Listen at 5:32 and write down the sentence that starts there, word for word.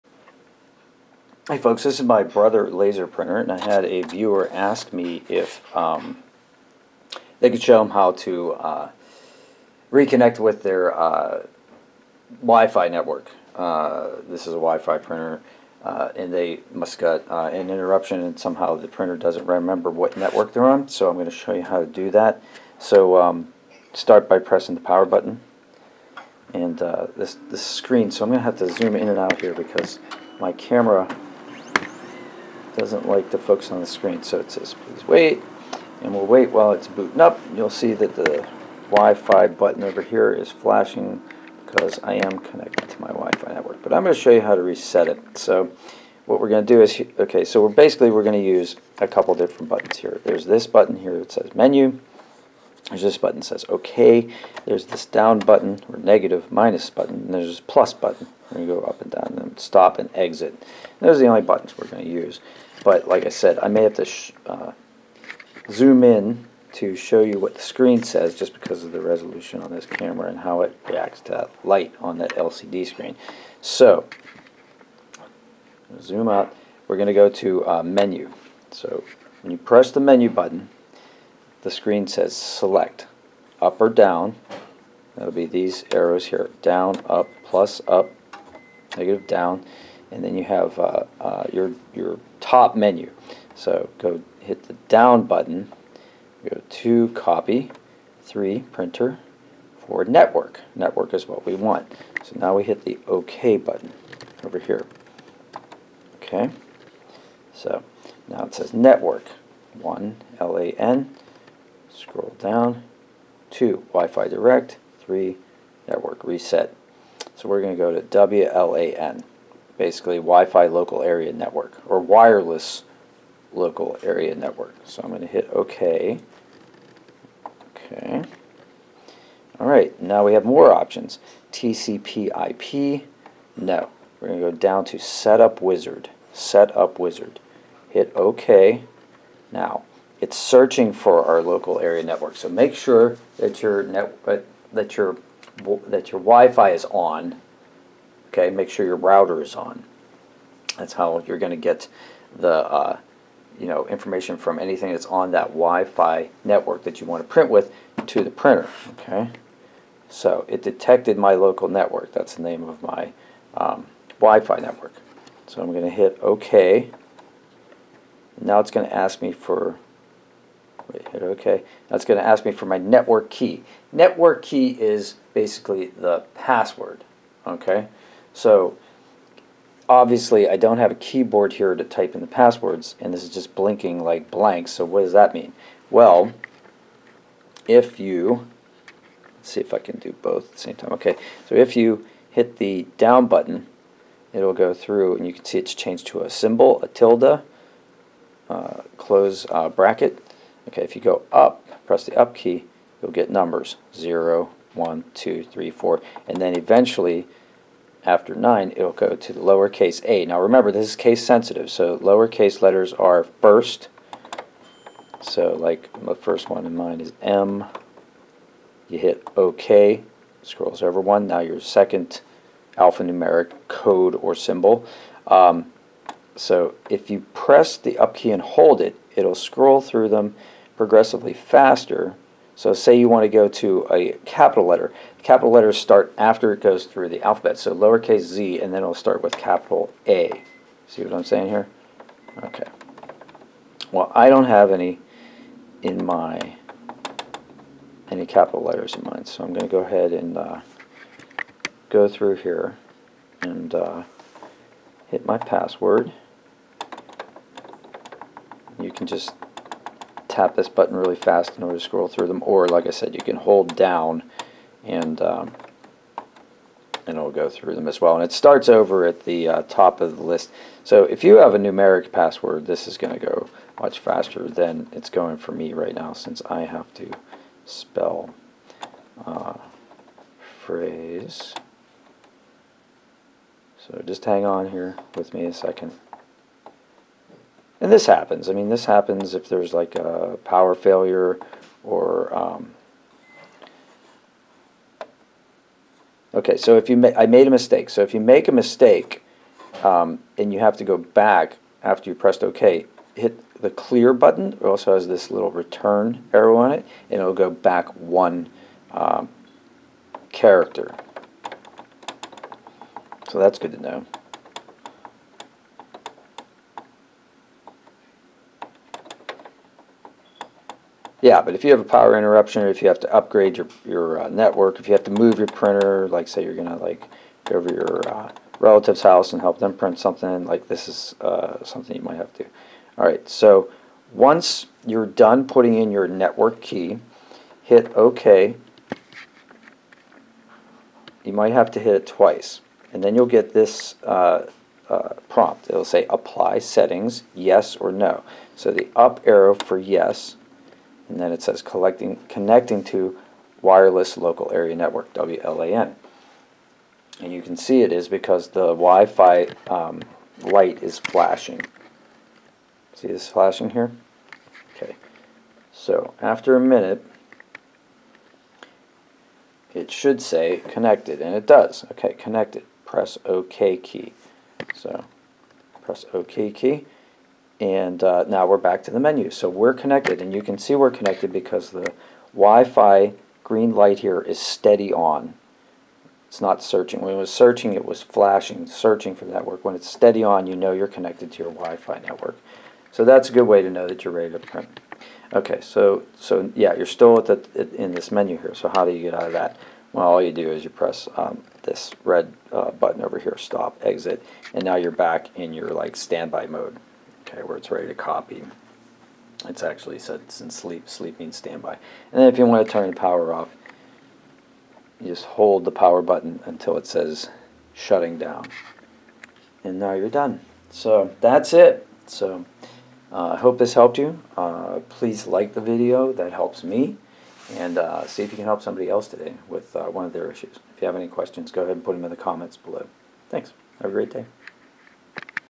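All right, so once you're done putting in your network key, hit OK.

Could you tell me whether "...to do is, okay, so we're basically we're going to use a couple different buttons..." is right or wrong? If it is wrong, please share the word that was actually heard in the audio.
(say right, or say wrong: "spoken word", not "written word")
right.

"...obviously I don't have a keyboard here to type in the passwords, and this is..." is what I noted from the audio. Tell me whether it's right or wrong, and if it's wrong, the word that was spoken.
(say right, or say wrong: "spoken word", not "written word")
right.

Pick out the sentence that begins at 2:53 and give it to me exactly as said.
Network key is basically the password.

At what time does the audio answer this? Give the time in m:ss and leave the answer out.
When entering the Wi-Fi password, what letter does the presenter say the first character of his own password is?
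3:37.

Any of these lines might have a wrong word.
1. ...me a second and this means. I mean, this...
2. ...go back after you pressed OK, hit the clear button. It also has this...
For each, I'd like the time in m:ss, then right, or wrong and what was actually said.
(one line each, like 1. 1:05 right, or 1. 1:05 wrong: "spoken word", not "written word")
1. 4:45 wrong: "happens", not "means"
2. 5:00 right.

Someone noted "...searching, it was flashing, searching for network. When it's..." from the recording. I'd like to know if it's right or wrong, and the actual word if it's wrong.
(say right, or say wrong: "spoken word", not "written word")
right.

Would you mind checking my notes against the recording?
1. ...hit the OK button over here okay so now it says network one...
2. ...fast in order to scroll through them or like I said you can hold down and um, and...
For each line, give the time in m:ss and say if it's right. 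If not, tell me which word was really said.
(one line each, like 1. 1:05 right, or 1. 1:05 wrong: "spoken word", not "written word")
1. 1:42 right
2. 4:21 right.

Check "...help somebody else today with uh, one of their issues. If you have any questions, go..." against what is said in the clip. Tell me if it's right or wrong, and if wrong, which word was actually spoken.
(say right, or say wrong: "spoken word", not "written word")
right.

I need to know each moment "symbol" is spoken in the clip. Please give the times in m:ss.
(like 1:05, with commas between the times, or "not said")
3:16, 3:44.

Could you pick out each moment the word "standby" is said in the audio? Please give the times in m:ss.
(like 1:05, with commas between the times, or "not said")
6:45, 6:51.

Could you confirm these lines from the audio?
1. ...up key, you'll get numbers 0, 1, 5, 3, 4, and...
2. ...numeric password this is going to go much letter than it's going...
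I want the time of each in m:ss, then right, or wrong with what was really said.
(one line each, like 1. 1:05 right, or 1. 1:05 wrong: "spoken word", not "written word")
1. 3:22 wrong: "2", not "5"
2. 4:31 wrong: "faster", not "letter".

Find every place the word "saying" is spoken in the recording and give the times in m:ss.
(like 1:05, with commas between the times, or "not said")
4:01.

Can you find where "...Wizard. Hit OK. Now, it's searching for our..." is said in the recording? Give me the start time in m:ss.
2:16.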